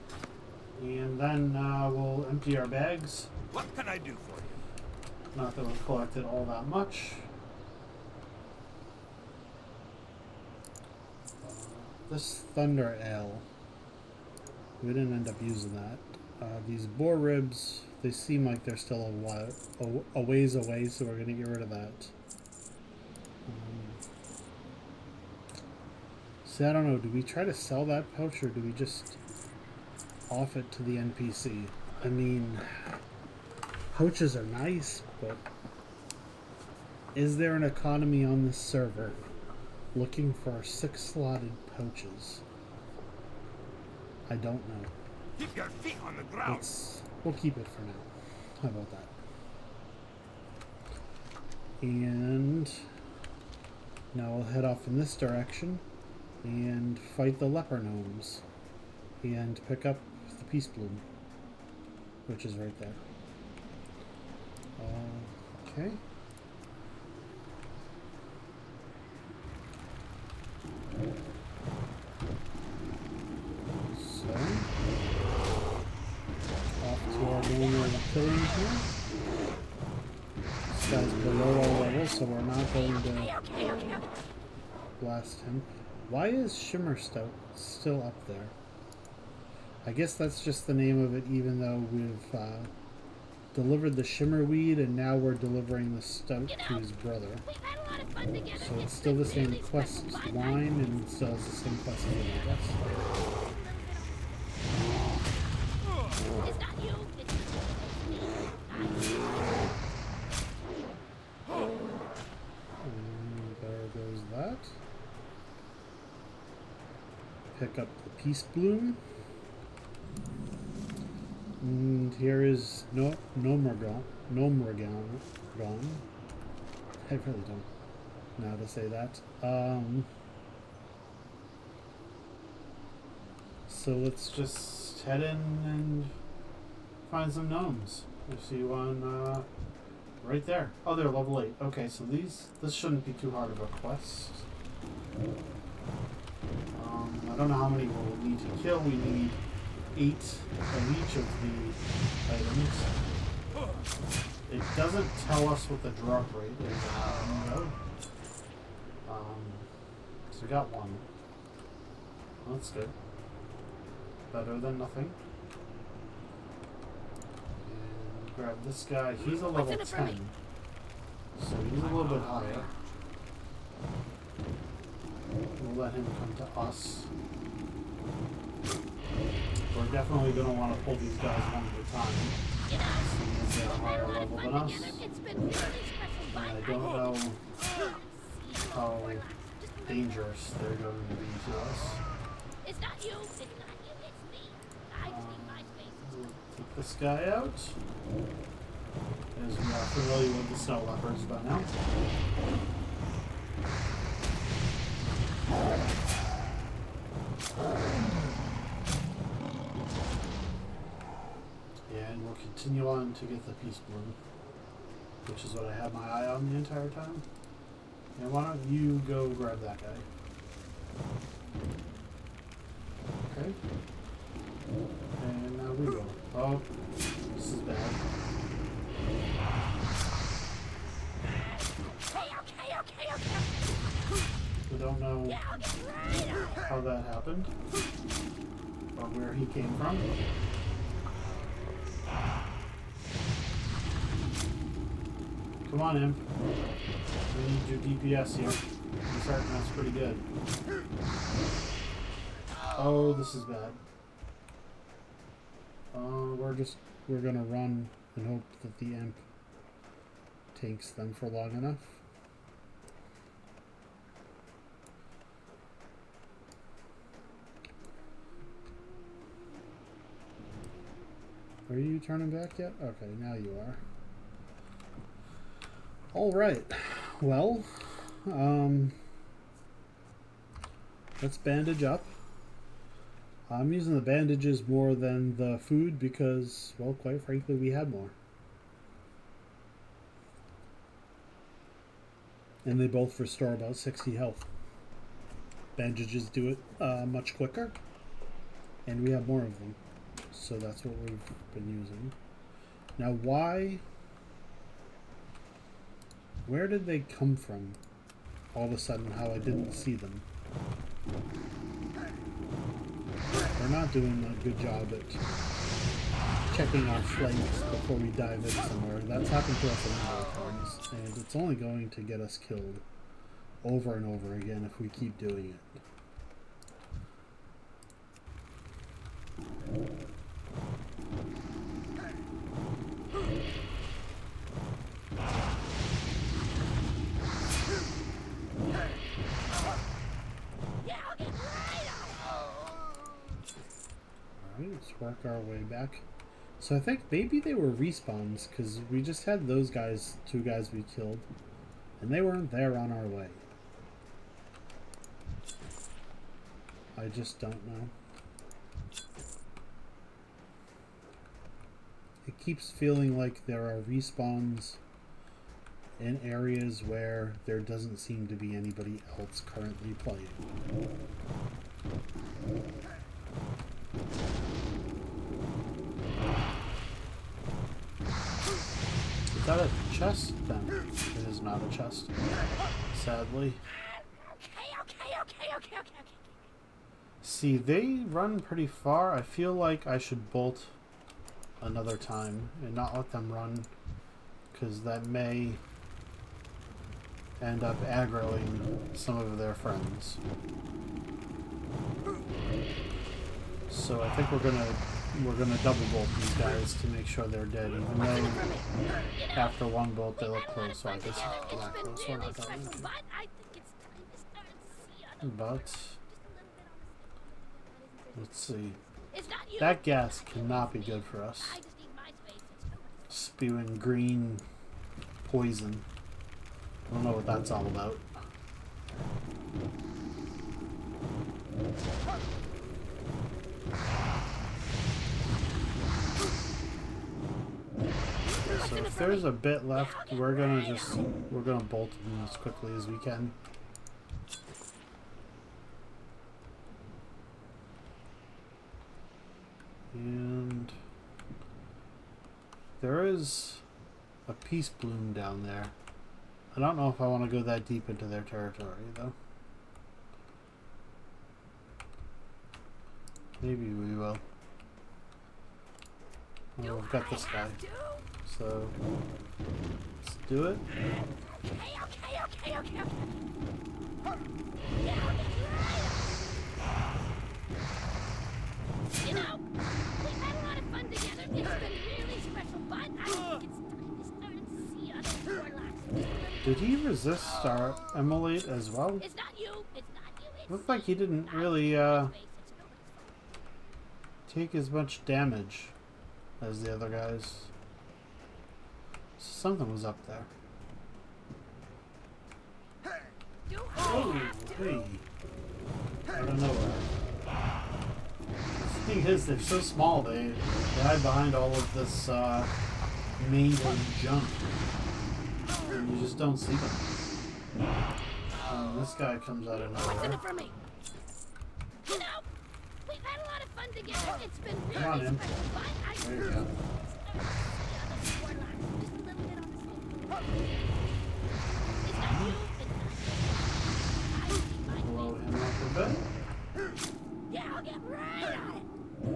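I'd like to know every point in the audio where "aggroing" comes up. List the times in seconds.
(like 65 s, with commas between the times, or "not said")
397 s.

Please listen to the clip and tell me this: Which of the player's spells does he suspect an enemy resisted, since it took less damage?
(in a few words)
Immolate.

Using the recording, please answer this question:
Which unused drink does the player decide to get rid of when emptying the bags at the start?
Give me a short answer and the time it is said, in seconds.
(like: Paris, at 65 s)
Thunder Ale, at 12 s.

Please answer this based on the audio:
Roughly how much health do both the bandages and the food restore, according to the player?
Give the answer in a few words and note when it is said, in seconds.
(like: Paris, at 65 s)
60, at 293 s.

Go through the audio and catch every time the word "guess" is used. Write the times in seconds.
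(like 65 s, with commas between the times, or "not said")
89 s, 106 s, 410 s.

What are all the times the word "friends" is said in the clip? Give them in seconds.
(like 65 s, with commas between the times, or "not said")
399 s.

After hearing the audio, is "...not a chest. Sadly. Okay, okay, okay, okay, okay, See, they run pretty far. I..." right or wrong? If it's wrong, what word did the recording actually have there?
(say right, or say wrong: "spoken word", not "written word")
right.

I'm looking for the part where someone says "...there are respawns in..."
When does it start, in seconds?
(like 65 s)
363 s.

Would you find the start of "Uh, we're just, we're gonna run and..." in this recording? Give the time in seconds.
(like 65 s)
255 s.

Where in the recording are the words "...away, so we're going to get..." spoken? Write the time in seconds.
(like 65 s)
20 s.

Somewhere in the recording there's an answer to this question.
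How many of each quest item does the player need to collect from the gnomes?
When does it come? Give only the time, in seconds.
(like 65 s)
149 s.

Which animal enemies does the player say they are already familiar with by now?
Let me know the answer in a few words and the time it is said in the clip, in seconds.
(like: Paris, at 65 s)
snow leopards, at 200 s.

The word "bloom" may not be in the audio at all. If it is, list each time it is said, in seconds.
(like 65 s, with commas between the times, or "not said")
60 s, 118 s, 213 s, 454 s.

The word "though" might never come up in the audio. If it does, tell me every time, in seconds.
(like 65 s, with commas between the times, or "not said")
91 s, 407 s, 458 s.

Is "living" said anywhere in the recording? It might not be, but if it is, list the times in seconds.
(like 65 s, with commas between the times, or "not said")
not said.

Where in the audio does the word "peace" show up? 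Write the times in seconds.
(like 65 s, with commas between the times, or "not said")
60 s, 118 s, 213 s, 454 s.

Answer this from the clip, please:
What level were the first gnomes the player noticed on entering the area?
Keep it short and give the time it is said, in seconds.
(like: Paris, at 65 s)
8, at 141 s.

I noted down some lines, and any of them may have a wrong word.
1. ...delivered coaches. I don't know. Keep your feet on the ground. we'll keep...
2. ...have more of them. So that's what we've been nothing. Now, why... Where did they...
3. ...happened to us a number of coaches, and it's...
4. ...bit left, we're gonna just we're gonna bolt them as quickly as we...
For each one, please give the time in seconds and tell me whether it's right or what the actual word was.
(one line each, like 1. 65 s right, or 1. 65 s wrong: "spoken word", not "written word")
1. 41 s wrong: "slotted", not "delivered"
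2. 299 s wrong: "using", not "nothing"
3. 319 s wrong: "times", not "coaches"
4. 439 s right.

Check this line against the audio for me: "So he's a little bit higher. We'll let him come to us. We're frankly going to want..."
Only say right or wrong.
wrong.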